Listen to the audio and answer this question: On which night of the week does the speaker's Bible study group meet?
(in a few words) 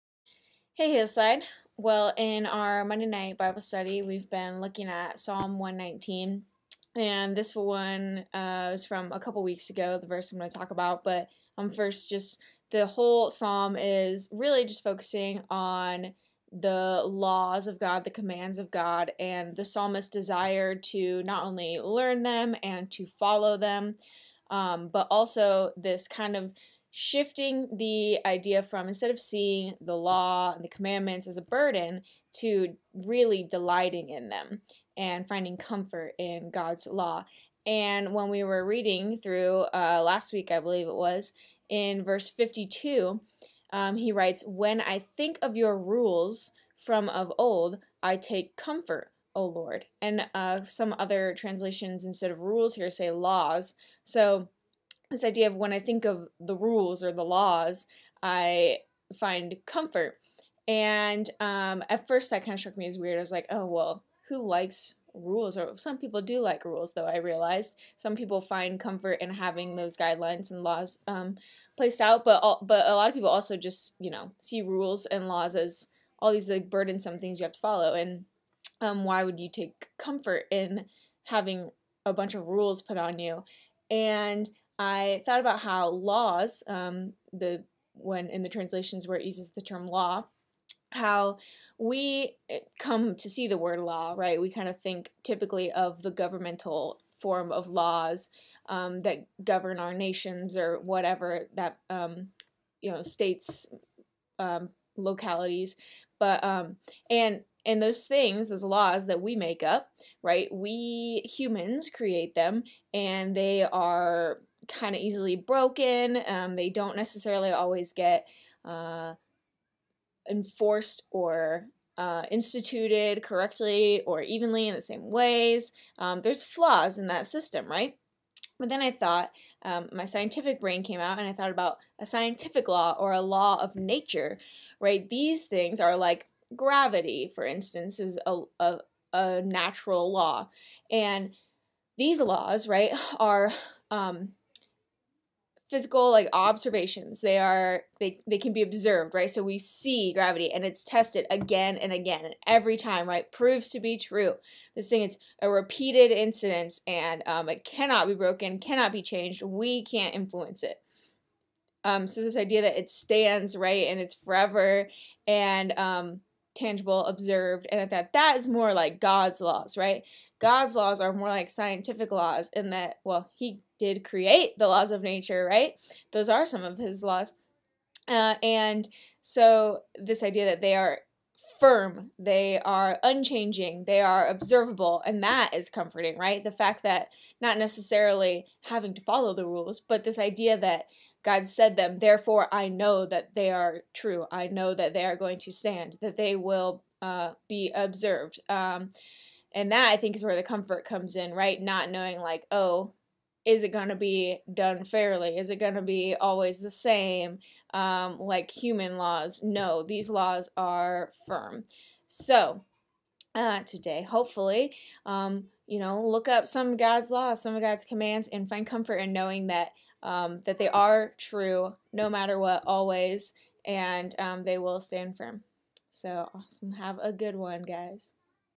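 Monday.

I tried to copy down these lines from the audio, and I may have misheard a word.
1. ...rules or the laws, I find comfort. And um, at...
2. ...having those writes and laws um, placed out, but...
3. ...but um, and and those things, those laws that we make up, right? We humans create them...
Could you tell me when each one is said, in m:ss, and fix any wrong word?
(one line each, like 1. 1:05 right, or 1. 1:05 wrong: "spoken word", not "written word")
1. 0:56 right
2. 1:09 wrong: "guidelines", not "writes"
3. 1:46 right.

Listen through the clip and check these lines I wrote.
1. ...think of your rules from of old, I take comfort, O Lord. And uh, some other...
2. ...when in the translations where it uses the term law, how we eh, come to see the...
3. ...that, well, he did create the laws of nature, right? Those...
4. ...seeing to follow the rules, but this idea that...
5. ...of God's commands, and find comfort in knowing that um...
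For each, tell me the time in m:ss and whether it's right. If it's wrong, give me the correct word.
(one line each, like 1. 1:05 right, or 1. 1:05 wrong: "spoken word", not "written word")
1. 0:45 right
2. 1:27 right
3. 2:52 right
4. 3:08 wrong: "having", not "seeing"
5. 3:37 right.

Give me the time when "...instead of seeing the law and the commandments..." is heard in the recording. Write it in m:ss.
0:28.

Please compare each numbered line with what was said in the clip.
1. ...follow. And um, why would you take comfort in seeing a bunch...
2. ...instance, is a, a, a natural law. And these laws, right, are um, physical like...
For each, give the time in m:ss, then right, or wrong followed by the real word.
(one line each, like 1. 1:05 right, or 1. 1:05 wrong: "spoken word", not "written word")
1. 1:17 wrong: "having", not "seeing"
2. 2:17 right.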